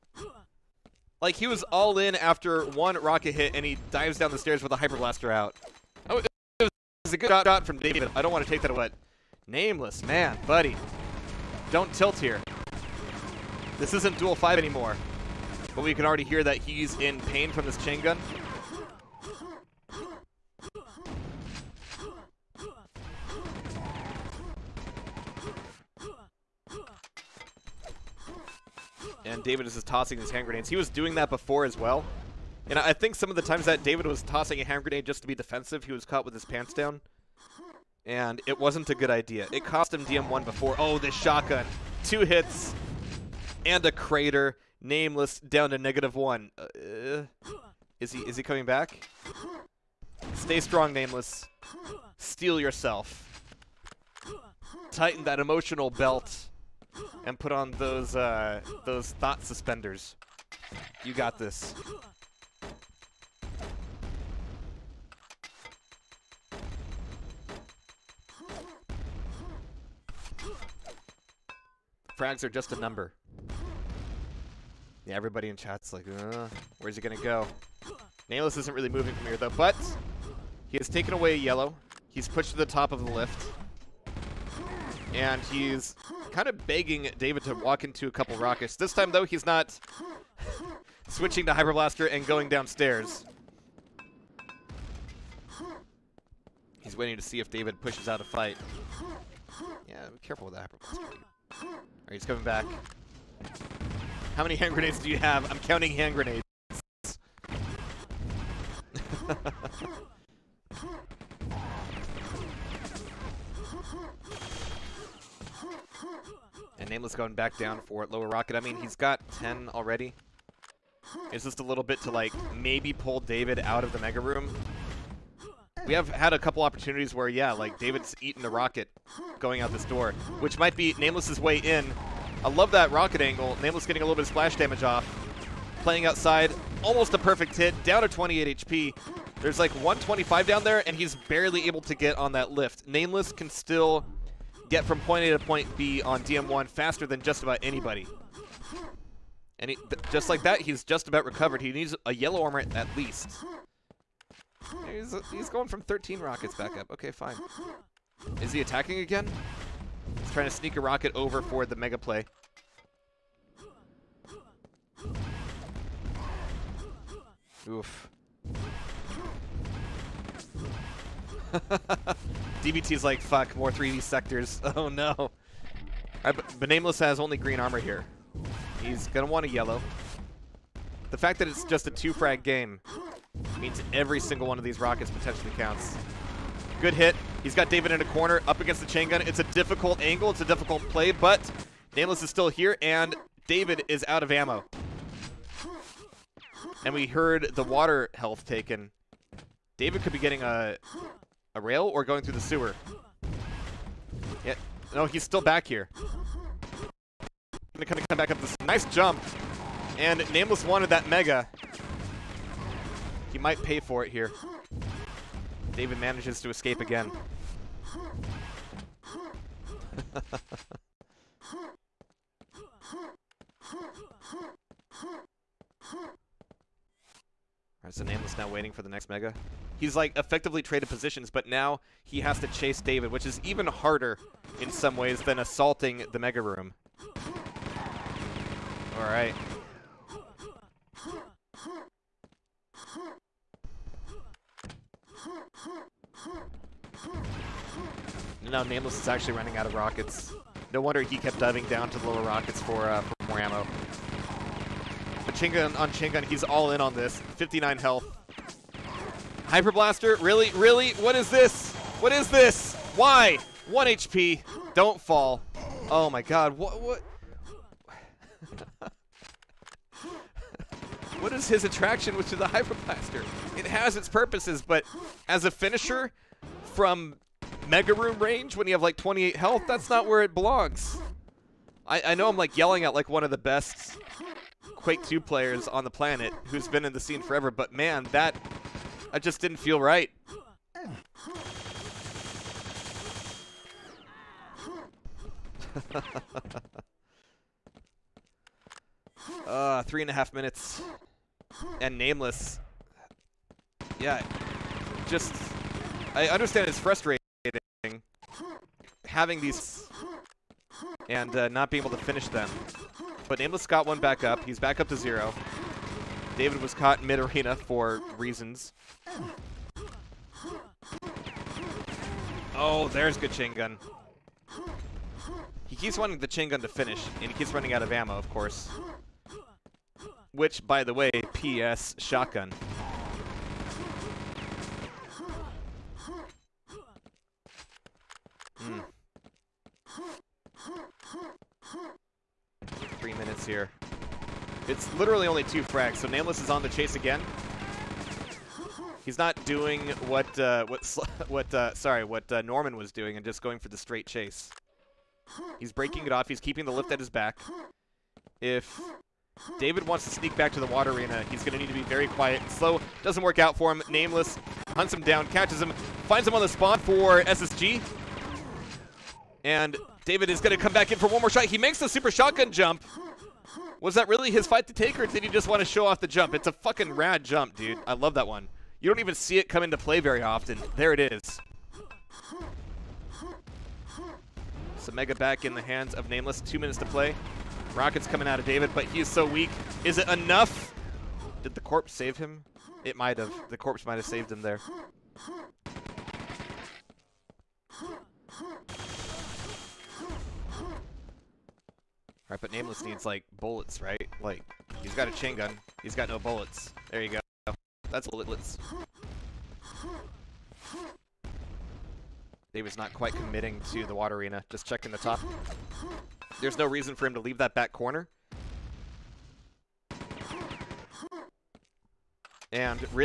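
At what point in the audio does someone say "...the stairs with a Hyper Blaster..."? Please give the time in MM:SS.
00:04.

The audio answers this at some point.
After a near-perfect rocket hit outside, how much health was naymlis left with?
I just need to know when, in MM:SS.
02:18.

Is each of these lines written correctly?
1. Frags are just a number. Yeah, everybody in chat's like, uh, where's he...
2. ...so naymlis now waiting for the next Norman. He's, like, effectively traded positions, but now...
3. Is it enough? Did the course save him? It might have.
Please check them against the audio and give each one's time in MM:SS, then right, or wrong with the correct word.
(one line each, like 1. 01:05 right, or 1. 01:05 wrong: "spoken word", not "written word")
1. 01:12 right
2. 03:47 wrong: "Mega", not "Norman"
3. 06:29 wrong: "corpse", not "course".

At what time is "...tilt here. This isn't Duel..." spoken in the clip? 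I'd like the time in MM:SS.
00:11.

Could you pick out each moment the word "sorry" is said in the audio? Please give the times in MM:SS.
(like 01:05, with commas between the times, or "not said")
05:51.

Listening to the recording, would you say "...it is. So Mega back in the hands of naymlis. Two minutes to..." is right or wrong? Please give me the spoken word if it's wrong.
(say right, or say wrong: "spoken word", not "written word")
right.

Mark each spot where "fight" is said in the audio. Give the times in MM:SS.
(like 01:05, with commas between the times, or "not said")
01:38, 06:14.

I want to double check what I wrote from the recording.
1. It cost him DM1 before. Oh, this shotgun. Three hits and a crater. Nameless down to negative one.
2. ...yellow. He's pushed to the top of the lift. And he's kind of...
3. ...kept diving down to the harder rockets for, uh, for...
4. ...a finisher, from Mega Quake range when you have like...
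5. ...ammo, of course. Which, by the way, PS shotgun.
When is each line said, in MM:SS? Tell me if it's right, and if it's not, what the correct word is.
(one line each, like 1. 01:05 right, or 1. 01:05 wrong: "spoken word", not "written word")
1. 00:39 wrong: "Two", not "Three"
2. 01:21 right
3. 04:11 wrong: "lower", not "harder"
4. 04:35 wrong: "Room", not "Quake"
5. 05:27 right.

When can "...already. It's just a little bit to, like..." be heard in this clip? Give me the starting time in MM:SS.
01:59.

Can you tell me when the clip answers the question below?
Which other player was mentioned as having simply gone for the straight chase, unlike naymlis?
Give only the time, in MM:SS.
05:52.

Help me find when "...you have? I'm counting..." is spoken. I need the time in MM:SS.
01:45.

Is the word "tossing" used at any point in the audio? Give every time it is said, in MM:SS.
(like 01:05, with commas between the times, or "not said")
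00:29, 00:34.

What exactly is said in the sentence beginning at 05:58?
If David wants to sneak back to the water arena, he's going to need to be very quiet and slow.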